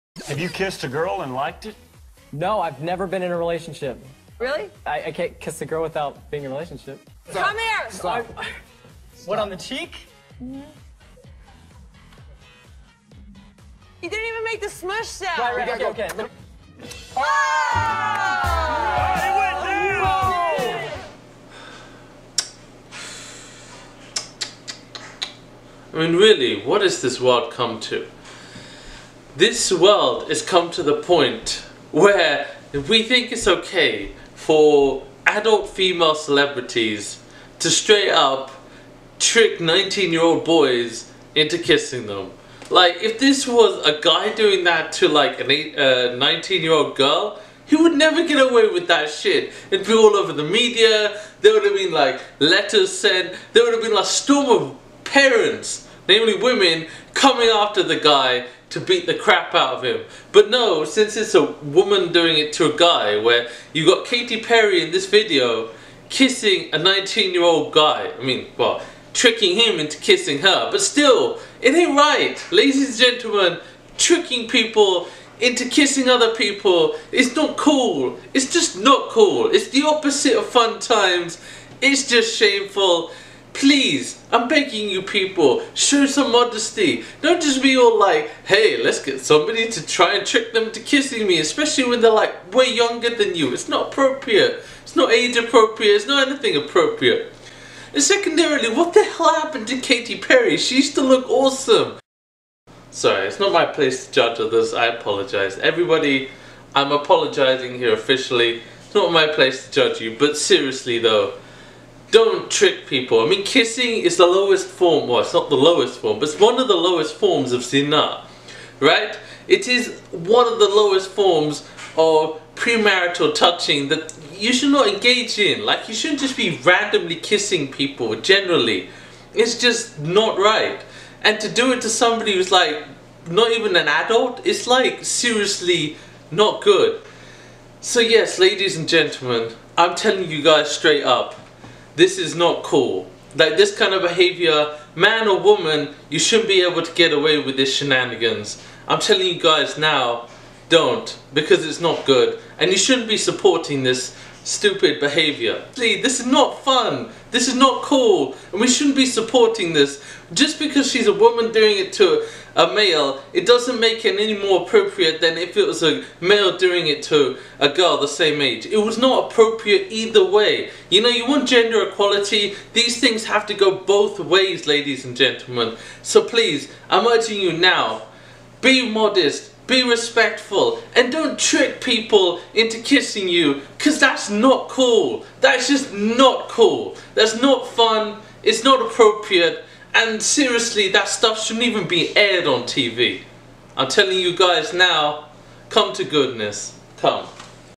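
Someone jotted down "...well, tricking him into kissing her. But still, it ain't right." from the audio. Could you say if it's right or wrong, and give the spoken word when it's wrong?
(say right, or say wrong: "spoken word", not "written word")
right.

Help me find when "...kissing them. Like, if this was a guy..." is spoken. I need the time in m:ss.
0:41.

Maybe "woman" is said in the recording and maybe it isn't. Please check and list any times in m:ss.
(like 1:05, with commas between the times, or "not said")
1:01, 2:25, 2:41.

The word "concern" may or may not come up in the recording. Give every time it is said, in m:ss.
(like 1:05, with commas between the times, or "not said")
not said.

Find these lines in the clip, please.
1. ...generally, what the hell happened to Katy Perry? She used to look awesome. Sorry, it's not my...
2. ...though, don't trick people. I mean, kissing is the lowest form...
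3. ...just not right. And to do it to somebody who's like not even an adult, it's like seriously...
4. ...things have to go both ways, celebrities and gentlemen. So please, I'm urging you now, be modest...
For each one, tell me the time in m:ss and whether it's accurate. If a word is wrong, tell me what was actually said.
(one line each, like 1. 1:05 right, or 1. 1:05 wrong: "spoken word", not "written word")
1. 1:38 wrong: "secondarily", not "generally"
2. 1:50 right
3. 2:09 right
4. 2:52 wrong: "ladies", not "celebrities".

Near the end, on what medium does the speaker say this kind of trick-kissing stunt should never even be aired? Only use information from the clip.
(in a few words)
TV.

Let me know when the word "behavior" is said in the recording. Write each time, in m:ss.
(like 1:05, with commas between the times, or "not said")
2:24, 2:34.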